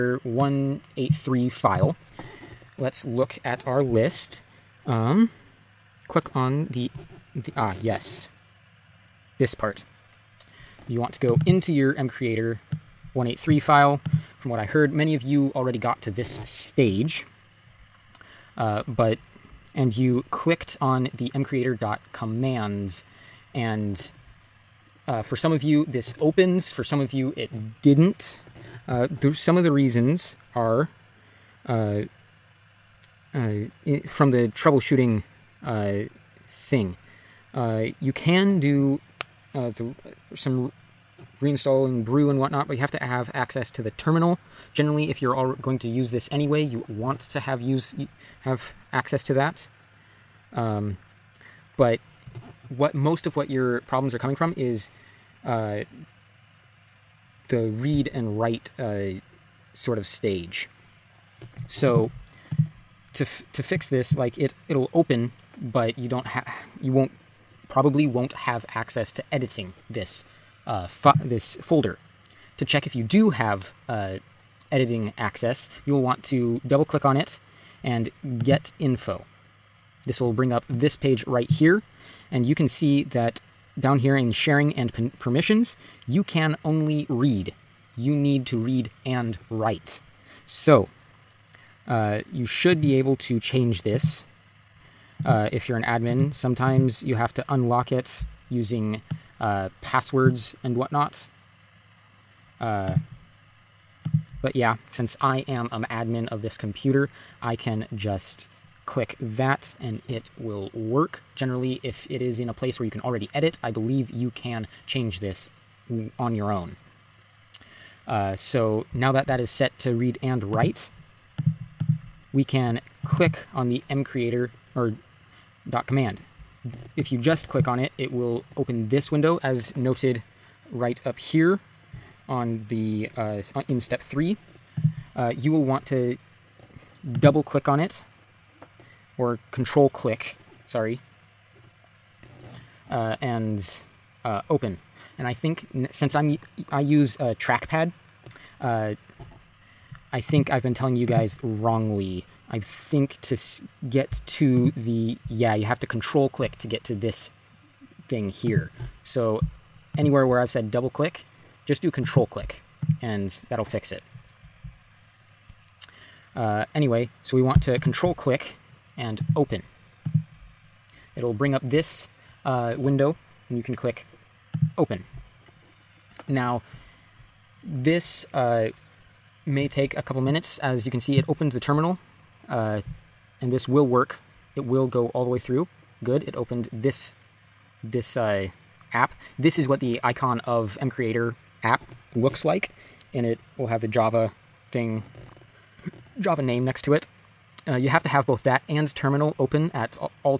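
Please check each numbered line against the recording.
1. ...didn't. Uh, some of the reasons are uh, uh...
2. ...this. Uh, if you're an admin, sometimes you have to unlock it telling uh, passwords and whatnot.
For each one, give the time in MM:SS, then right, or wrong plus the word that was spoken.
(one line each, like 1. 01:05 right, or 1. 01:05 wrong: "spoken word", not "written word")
1. 00:27 right
2. 01:33 wrong: "using", not "telling".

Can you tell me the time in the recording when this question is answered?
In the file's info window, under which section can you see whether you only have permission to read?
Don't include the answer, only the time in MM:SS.
01:24.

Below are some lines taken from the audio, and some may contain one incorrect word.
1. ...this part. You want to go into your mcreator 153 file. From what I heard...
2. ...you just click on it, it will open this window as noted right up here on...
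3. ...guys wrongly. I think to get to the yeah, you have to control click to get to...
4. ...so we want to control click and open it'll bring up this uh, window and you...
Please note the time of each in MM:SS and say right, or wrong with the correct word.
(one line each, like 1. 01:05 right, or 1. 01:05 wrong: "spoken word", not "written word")
1. 00:09 wrong: "183", not "153"
2. 02:07 right
3. 02:31 right
4. 02:47 right.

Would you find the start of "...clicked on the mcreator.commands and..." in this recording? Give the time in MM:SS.
00:20.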